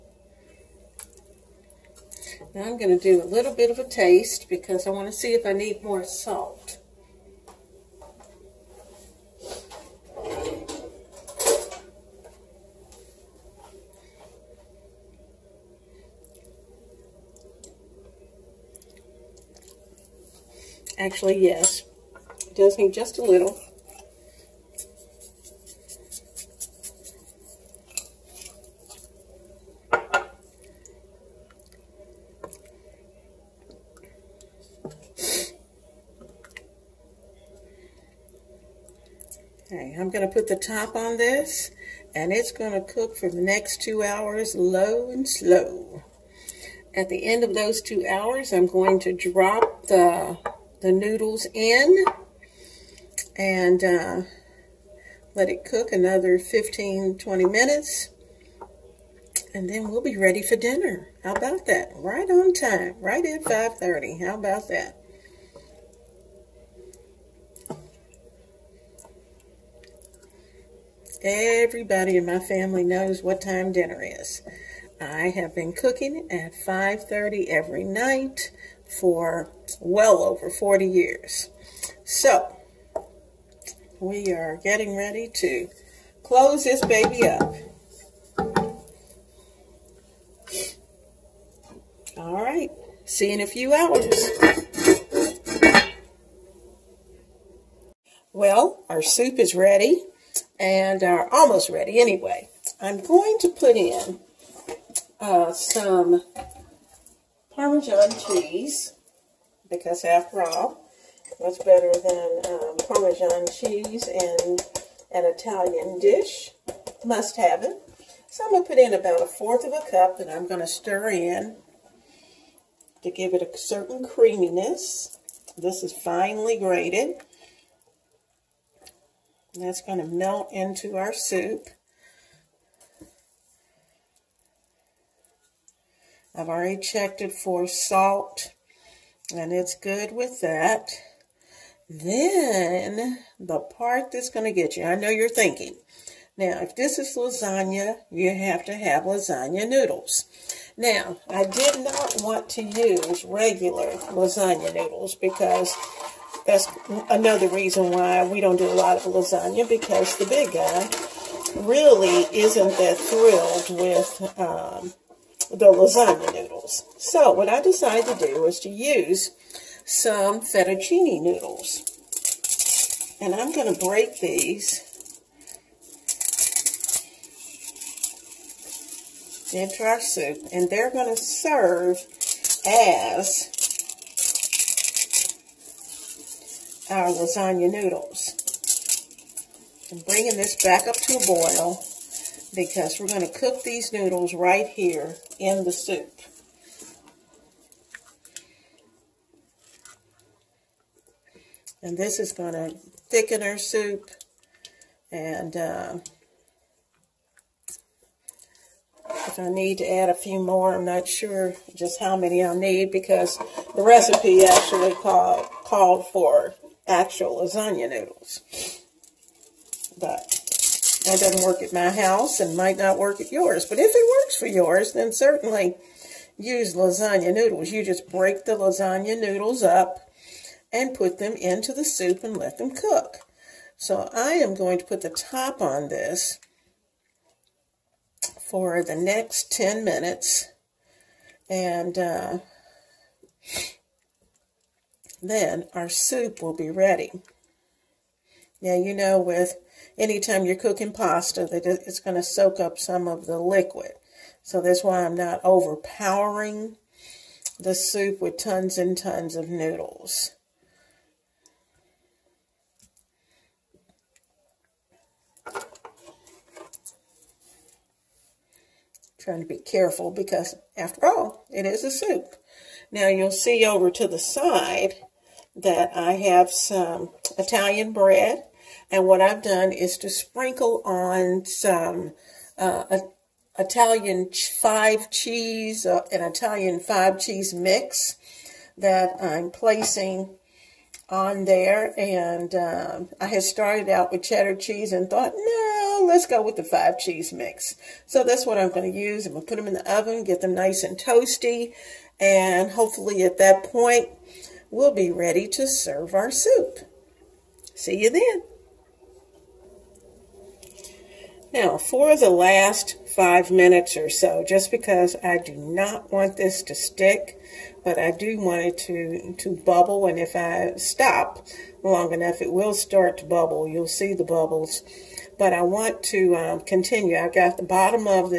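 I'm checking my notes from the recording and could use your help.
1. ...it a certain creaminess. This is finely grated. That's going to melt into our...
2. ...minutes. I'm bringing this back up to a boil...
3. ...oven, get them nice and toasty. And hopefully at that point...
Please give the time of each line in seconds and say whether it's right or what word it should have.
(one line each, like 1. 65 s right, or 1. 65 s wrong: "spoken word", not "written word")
1. 123 s right
2. 187 s wrong: "noodles", not "minutes"
3. 299 s right.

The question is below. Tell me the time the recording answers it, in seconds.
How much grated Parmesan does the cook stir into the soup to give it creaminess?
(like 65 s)
119 s.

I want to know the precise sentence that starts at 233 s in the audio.
So I am going to put the top on this for the next 10 minutes.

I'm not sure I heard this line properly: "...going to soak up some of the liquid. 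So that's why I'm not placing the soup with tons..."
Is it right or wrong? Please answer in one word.
wrong.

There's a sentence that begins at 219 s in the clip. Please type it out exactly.
But that doesn't work at my house and might not work at yours.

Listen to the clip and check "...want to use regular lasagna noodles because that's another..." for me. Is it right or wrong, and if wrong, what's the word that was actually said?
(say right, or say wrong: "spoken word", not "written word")
right.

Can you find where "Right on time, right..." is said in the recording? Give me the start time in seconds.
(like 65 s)
61 s.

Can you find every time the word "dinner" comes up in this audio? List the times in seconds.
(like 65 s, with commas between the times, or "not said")
60 s, 73 s.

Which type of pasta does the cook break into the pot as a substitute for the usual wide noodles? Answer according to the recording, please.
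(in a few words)
Fettuccine.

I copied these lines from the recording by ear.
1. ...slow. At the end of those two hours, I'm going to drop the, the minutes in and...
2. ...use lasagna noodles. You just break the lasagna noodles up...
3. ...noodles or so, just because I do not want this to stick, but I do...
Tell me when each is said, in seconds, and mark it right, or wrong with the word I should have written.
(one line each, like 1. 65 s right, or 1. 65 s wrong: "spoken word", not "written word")
1. 45 s wrong: "noodles", not "minutes"
2. 226 s right
3. 313 s wrong: "minutes", not "noodles".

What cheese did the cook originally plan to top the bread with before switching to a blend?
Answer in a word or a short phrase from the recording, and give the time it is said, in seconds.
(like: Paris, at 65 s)
Cheddar, at 294 s.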